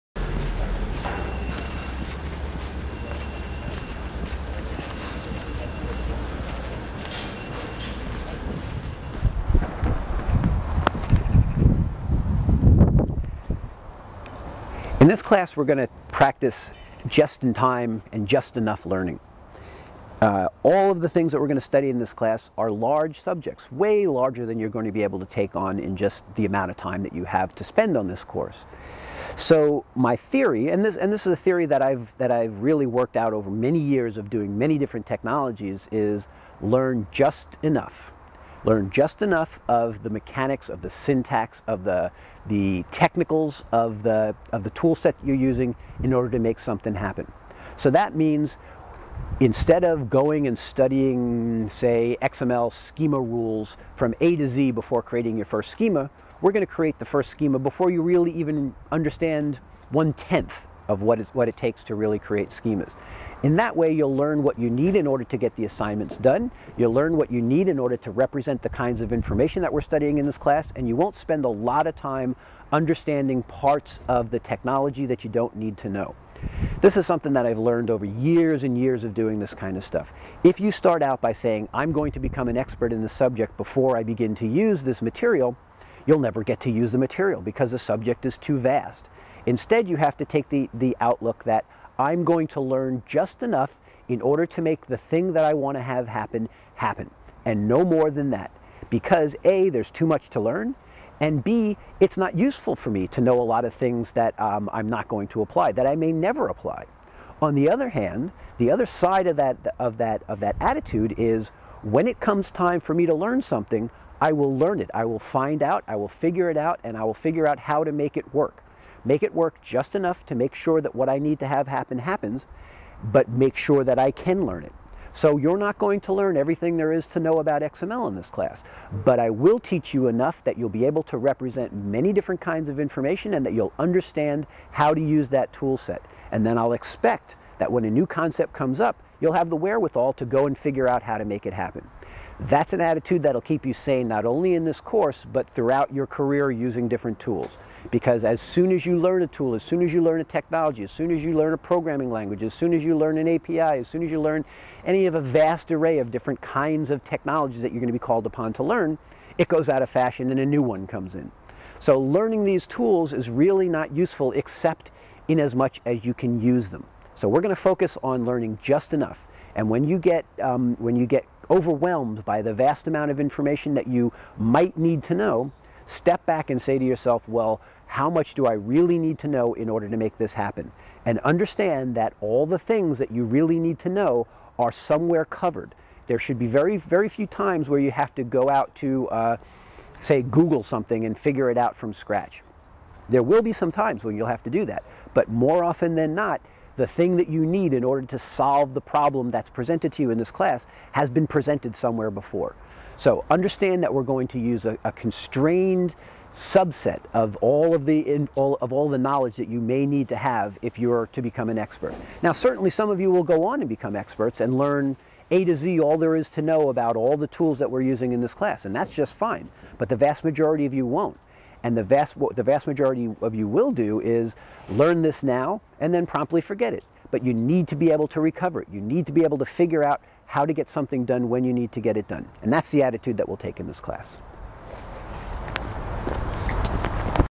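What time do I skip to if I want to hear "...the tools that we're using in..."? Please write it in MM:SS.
03:37.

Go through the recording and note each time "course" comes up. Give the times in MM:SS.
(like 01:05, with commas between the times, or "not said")
00:28, 02:24.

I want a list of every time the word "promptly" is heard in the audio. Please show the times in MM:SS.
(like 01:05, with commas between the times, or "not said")
03:46.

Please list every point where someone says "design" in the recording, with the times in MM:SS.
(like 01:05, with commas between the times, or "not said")
not said.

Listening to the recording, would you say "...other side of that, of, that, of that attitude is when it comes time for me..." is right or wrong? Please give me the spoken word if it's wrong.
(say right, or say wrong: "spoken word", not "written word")
right.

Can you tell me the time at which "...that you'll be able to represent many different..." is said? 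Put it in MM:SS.
02:10.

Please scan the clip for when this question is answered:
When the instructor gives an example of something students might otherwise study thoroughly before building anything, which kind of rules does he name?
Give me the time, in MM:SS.
00:52.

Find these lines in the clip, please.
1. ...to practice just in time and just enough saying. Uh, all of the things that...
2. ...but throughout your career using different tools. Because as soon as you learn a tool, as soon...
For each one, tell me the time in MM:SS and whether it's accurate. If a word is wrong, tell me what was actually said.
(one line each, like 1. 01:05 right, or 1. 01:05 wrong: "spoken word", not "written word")
1. 00:15 wrong: "learning", not "saying"
2. 02:25 right.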